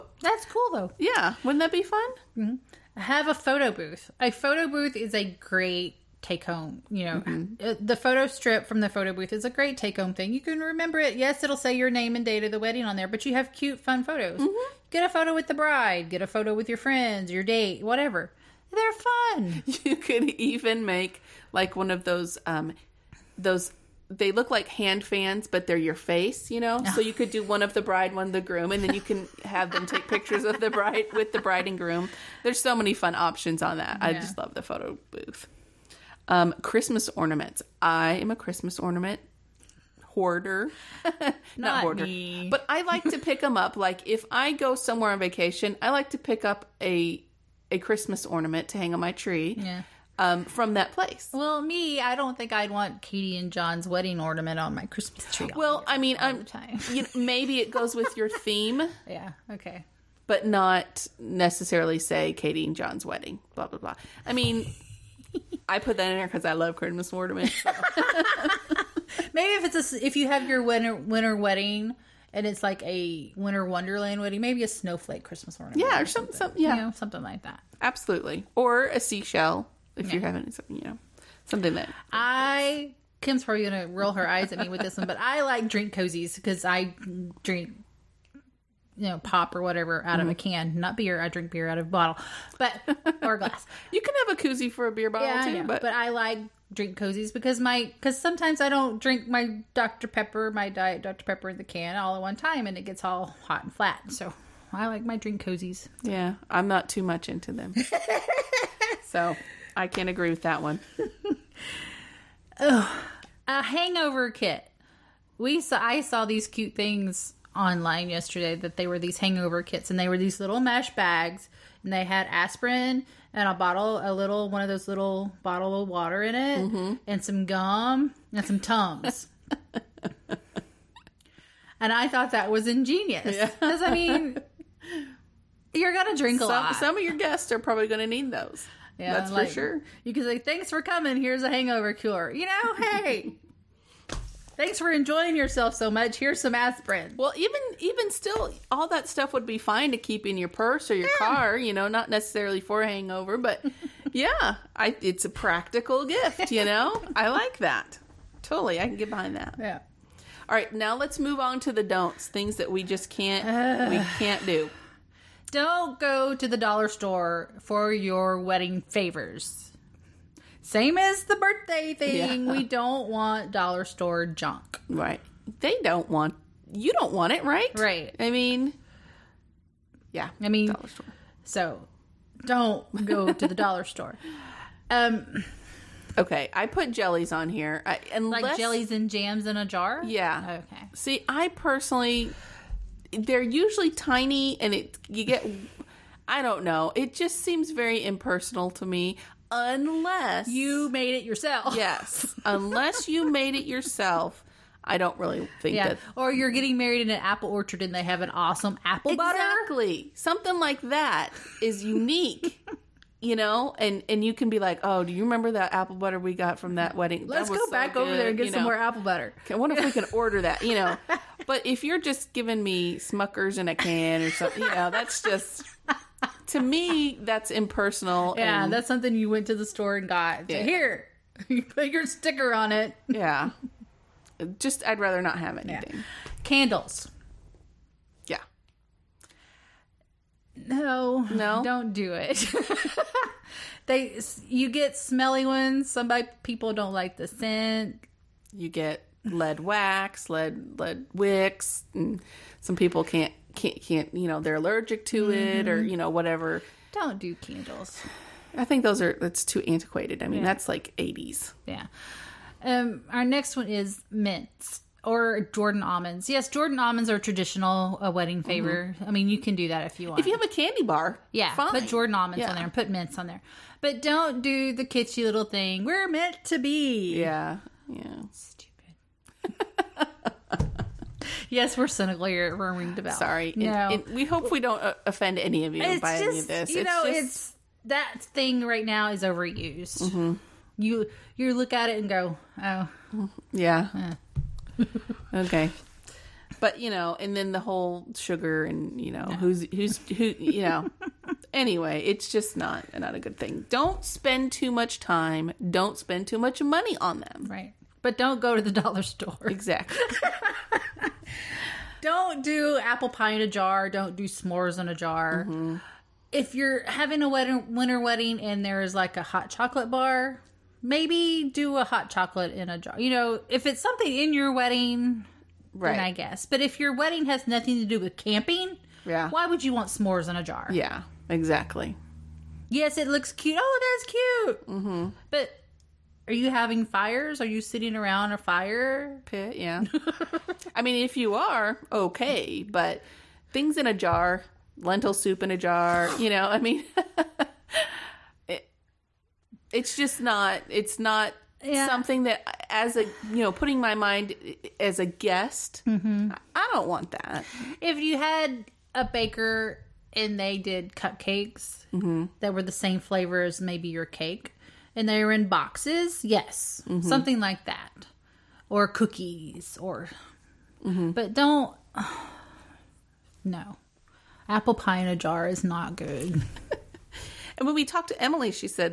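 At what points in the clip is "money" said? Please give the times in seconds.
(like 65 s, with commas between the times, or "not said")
306 s.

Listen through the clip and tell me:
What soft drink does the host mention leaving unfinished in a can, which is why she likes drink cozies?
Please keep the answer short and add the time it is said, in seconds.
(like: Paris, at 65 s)
Diet Dr Pepper, at 100 s.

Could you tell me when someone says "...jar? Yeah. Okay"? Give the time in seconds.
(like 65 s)
189 s.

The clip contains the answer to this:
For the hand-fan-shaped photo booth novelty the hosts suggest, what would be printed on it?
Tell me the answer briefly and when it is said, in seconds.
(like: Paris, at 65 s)
your face, at 25 s.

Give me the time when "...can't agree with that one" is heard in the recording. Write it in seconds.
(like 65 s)
109 s.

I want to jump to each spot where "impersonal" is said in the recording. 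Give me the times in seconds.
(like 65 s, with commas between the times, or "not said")
198 s, 227 s.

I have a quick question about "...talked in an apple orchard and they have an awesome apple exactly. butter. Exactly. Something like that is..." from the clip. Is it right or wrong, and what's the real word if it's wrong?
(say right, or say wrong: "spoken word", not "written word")
wrong: "married", not "talked".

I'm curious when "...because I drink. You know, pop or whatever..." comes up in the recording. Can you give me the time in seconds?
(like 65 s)
86 s.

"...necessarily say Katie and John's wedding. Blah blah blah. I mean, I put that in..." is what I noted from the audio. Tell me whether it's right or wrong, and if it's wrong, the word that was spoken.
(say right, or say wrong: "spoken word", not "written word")
right.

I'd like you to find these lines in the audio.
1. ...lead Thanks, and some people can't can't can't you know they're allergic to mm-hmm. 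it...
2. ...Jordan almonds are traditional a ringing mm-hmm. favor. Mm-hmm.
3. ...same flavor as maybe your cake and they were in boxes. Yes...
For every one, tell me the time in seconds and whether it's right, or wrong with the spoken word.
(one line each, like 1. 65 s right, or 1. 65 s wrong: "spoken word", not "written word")
1. 250 s wrong: "wicks", not "Thanks"
2. 266 s wrong: "wedding", not "ringing"
3. 362 s right.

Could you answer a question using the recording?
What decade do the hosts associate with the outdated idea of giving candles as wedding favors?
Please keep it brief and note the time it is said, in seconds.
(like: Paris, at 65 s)
the 80s, at 260 s.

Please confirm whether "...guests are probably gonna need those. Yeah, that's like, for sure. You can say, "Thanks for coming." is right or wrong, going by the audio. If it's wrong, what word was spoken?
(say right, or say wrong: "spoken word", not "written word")
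right.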